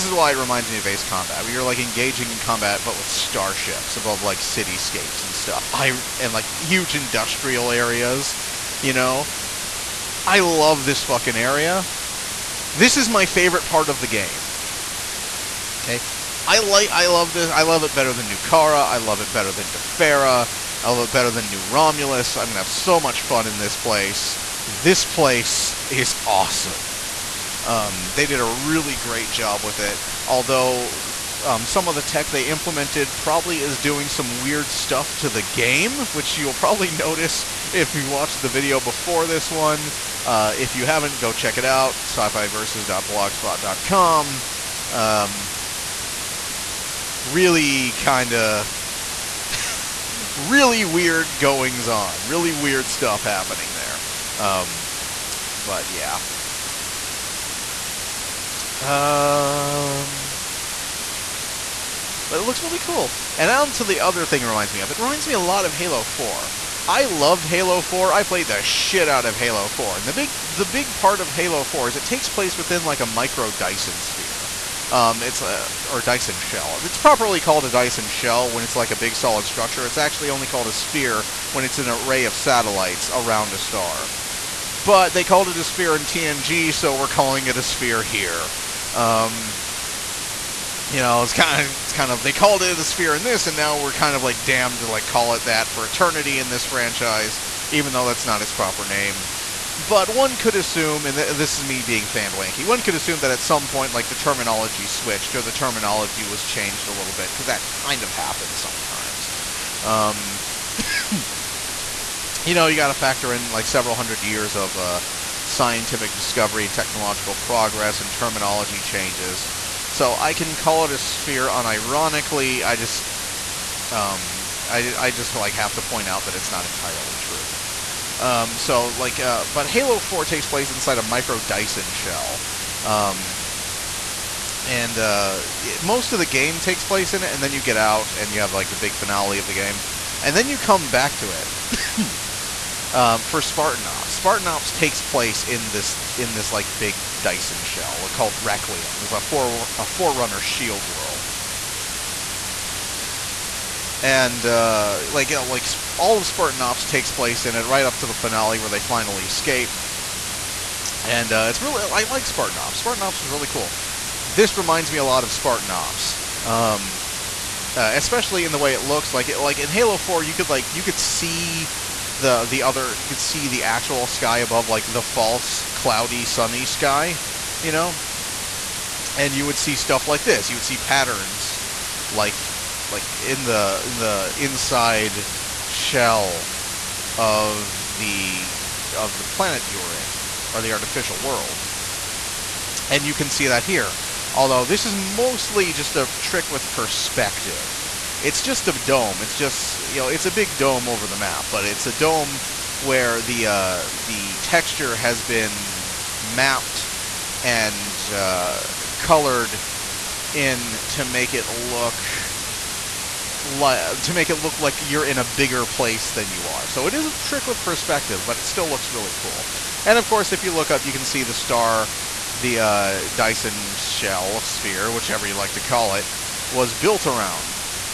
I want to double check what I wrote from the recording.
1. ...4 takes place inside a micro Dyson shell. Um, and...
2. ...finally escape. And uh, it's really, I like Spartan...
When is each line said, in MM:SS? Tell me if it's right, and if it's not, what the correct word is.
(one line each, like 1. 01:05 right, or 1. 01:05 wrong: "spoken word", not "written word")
1. 02:10 right
2. 02:38 right.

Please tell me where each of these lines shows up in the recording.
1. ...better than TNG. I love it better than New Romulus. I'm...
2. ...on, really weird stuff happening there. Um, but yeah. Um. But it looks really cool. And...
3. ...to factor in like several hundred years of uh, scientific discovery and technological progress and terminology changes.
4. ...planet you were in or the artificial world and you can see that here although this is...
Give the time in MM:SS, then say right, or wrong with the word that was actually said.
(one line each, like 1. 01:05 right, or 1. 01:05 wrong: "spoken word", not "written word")
1. 00:19 wrong: "Defera", not "TNG"
2. 00:51 right
3. 01:52 right
4. 03:09 right.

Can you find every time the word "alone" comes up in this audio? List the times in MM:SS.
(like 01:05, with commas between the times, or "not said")
not said.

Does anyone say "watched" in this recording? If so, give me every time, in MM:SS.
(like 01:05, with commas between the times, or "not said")
00:38.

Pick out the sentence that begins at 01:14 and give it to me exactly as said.
Um, it's a or Dyson shell.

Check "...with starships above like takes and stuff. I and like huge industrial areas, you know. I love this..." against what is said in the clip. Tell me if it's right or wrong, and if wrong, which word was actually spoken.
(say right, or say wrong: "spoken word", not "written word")
wrong: "cityscapes", not "takes".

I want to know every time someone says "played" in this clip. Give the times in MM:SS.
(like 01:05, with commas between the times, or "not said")
01:08.